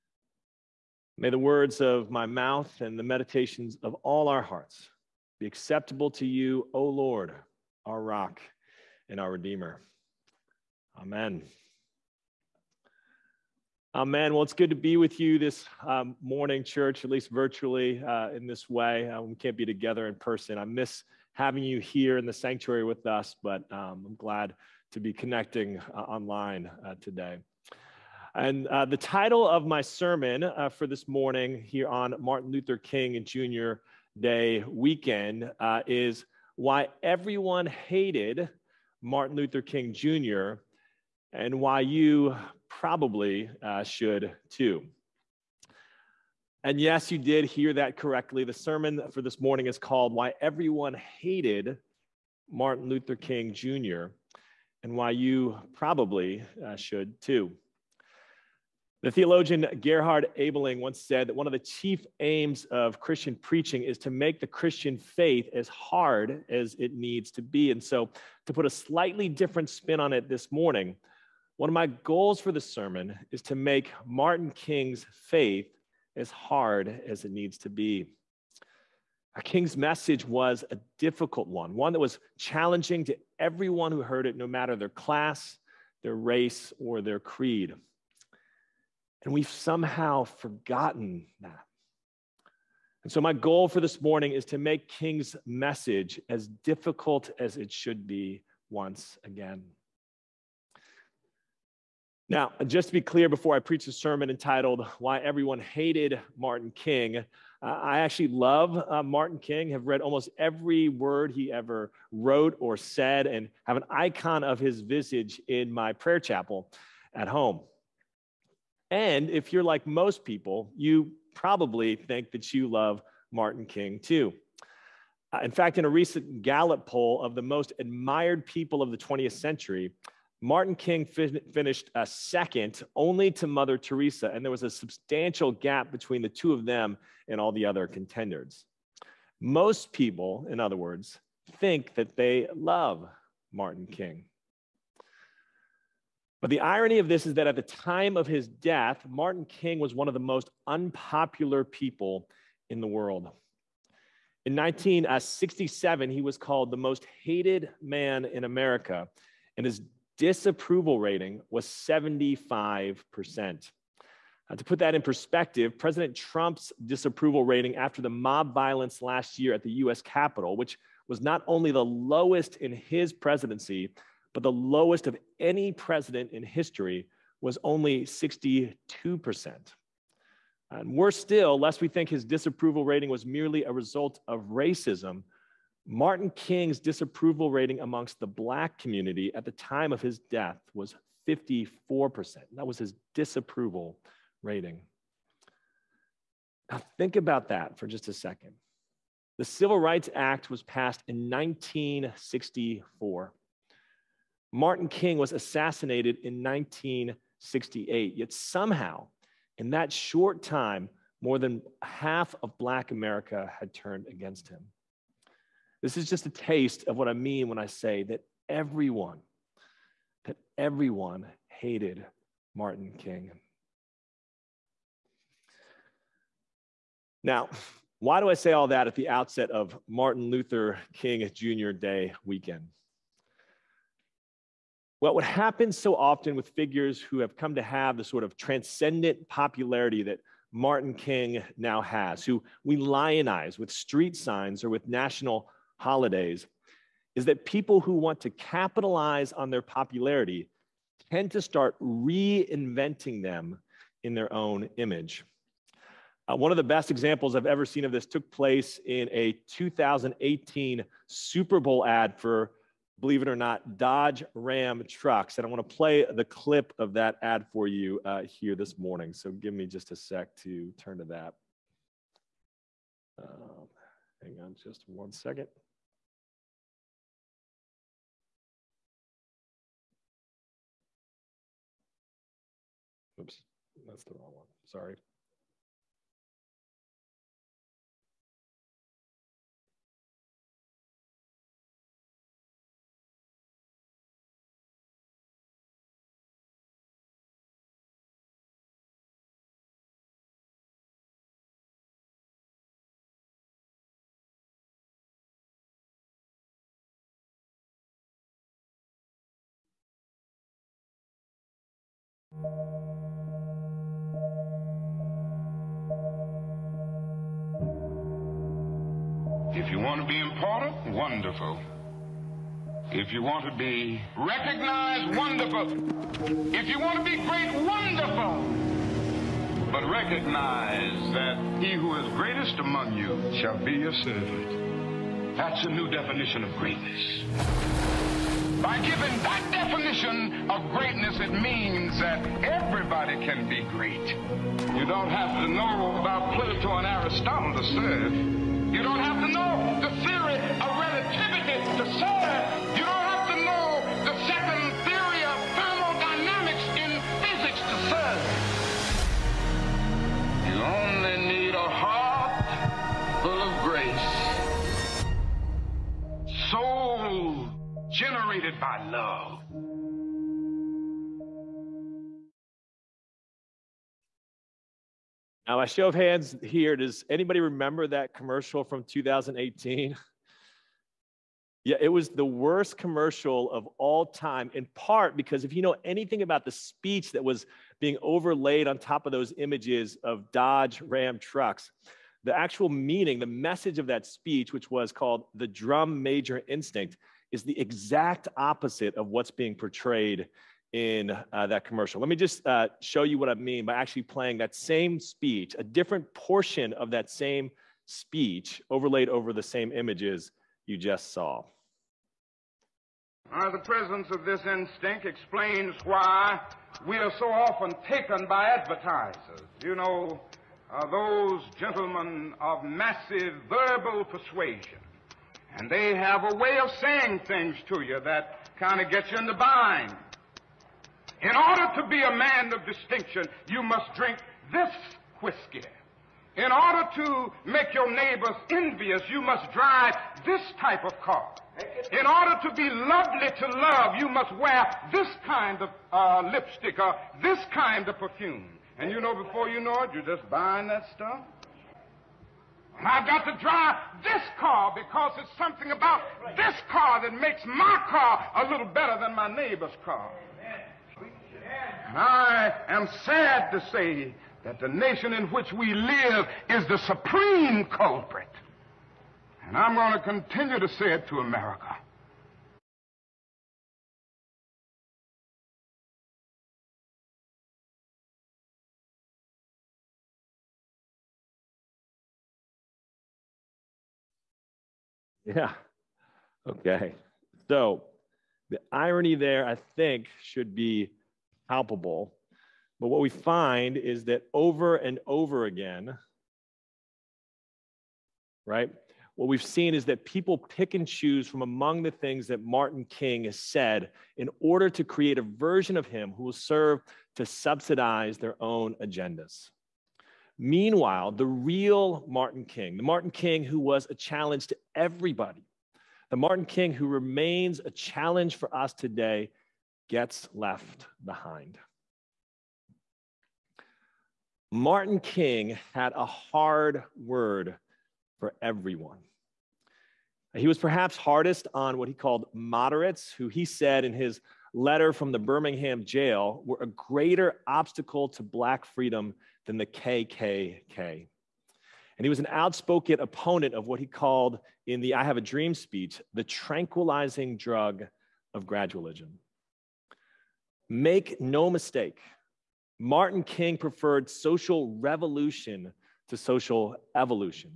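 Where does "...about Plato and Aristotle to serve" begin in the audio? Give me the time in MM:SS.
05:45.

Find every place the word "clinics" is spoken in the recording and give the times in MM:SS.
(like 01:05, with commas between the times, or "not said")
not said.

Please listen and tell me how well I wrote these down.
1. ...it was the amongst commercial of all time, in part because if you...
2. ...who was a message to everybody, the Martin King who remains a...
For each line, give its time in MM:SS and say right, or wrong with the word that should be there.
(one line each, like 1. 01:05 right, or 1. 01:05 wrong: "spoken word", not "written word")
1. 06:21 wrong: "worst", not "amongst"
2. 08:33 wrong: "challenge", not "message".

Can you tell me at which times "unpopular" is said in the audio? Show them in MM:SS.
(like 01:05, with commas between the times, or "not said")
02:30.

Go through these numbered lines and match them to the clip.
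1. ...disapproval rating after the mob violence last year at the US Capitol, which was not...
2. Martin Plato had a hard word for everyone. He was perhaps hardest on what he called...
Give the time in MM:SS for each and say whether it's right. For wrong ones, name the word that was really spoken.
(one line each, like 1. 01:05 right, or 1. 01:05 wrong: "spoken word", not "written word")
1. 02:46 right
2. 08:44 wrong: "King", not "Plato".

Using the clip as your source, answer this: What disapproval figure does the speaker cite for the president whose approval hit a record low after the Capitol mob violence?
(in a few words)
62%.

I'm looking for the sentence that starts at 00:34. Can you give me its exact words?
Day weekend uh, is Why Everyone Hated Martin Luther King Jr.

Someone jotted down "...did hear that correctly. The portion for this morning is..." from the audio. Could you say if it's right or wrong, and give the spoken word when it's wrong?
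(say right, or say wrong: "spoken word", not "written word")
wrong: "sermon", not "portion".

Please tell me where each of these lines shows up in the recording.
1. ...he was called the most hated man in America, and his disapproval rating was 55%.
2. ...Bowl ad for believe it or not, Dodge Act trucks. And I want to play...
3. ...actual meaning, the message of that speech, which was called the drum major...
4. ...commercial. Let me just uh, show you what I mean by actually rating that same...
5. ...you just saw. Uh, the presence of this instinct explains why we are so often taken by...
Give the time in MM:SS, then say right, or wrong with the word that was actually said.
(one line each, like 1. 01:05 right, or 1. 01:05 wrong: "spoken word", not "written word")
1. 02:36 wrong: "75", not "55"
2. 04:21 wrong: "Ram", not "Act"
3. 06:32 right
4. 06:41 wrong: "playing", not "rating"
5. 06:50 right.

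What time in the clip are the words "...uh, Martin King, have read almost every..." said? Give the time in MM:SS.
01:48.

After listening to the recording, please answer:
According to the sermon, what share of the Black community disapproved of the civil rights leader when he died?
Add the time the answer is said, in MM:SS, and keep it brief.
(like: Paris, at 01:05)
54%, at 03:11.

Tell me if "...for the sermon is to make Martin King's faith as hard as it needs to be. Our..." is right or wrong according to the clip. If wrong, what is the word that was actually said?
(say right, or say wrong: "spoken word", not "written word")
right.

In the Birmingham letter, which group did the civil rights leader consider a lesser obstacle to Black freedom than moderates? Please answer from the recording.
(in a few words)
the KKK.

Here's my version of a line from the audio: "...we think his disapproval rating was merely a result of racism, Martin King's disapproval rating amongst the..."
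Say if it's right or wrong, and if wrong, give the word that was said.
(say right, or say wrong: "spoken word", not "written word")
right.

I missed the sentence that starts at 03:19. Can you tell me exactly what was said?
The Civil Rights Act was passed in 1964.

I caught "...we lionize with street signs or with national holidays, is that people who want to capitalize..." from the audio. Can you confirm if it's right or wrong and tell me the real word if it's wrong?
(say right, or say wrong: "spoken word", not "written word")
right.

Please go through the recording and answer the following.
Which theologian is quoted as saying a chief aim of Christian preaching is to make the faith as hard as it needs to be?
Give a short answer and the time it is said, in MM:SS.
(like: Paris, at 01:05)
Gerhard Ebeling, at 00:59.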